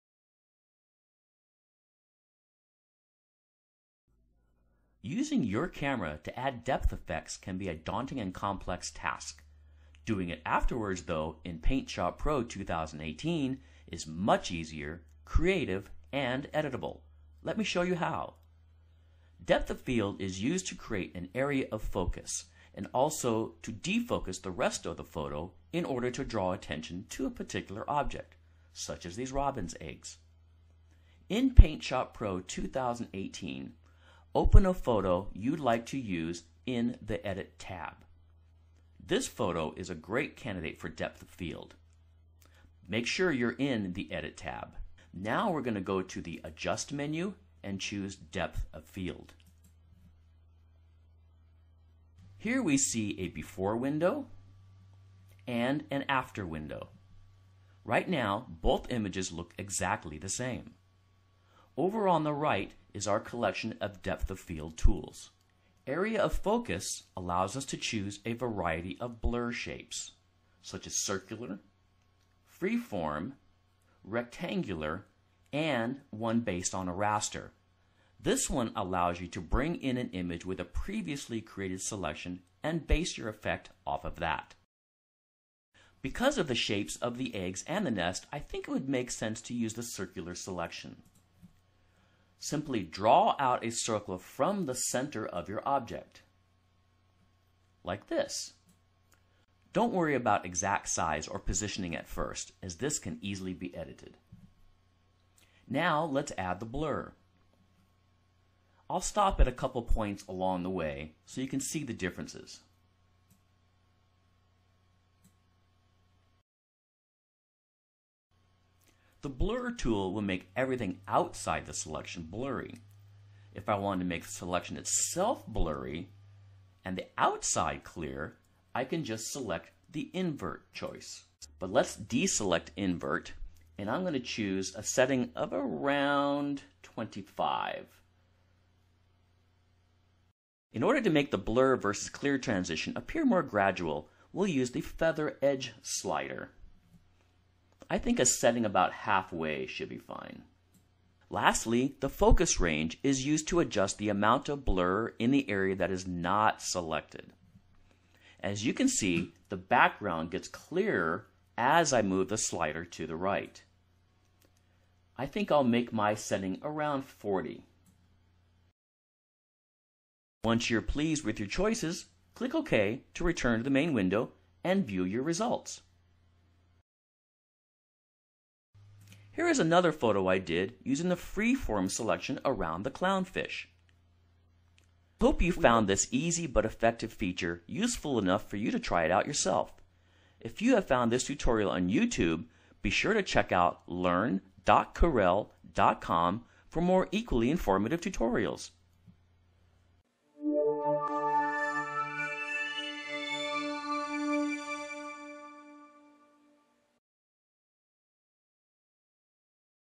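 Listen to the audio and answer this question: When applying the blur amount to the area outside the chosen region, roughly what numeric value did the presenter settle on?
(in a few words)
25.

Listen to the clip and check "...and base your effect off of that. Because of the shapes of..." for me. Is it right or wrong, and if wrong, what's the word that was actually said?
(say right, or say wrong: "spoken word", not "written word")
right.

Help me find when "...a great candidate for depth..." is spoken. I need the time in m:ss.
0:39.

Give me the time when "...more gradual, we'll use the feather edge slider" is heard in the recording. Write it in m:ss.
2:23.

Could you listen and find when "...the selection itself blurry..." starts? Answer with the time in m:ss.
2:04.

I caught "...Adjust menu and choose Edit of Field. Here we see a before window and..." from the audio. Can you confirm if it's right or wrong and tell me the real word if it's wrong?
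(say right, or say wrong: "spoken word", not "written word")
wrong: "Depth", not "Edit".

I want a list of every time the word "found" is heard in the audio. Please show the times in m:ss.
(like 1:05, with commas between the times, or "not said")
3:05, 3:10.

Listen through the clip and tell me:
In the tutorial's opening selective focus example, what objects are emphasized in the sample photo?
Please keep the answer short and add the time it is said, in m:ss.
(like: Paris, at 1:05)
robin's eggs, at 0:29.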